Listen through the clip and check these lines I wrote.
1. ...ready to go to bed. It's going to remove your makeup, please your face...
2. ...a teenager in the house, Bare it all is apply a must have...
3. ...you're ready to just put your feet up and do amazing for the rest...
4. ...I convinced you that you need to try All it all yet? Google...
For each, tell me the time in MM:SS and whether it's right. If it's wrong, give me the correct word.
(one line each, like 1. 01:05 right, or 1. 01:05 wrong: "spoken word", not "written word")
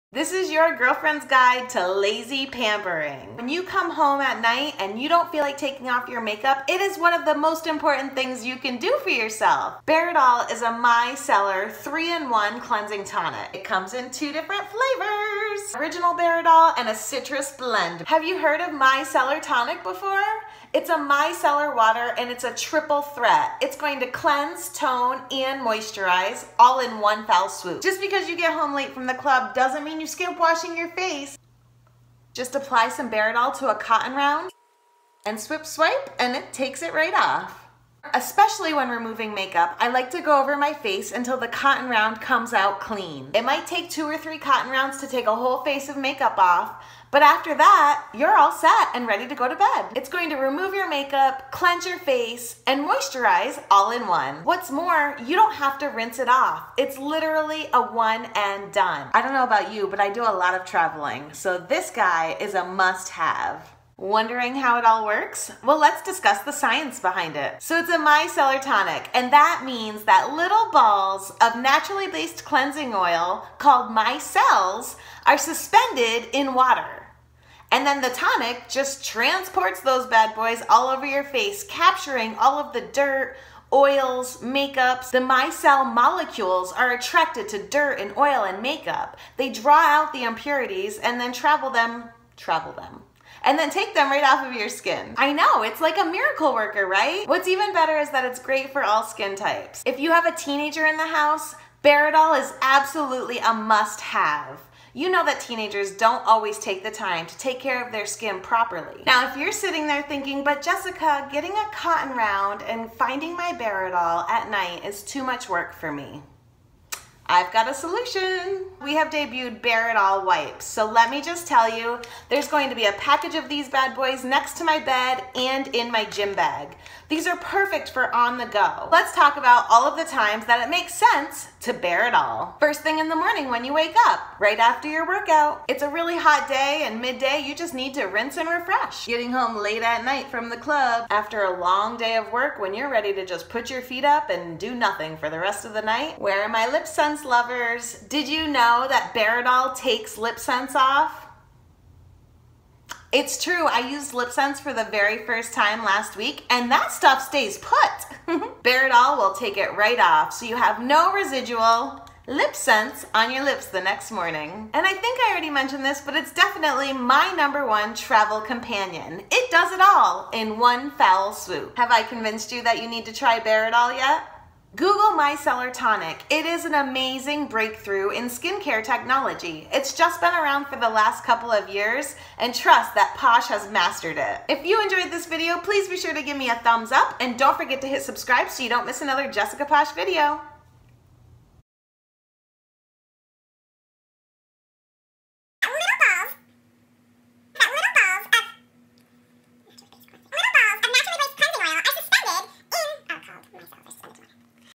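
1. 00:49 wrong: "cleanse", not "please"
2. 01:40 wrong: "absolutely", not "apply"
3. 02:22 wrong: "nothing", not "amazing"
4. 02:51 wrong: "Bare", not "All".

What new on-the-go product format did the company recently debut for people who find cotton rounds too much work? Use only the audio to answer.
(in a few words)
Bare it all wipes.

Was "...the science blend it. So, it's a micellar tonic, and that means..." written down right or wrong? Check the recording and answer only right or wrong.
wrong.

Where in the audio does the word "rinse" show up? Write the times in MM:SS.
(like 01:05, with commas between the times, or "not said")
00:55, 02:18.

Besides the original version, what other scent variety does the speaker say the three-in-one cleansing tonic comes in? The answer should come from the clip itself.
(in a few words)
Citrus blend.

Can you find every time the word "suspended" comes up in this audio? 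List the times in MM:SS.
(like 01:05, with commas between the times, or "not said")
01:15.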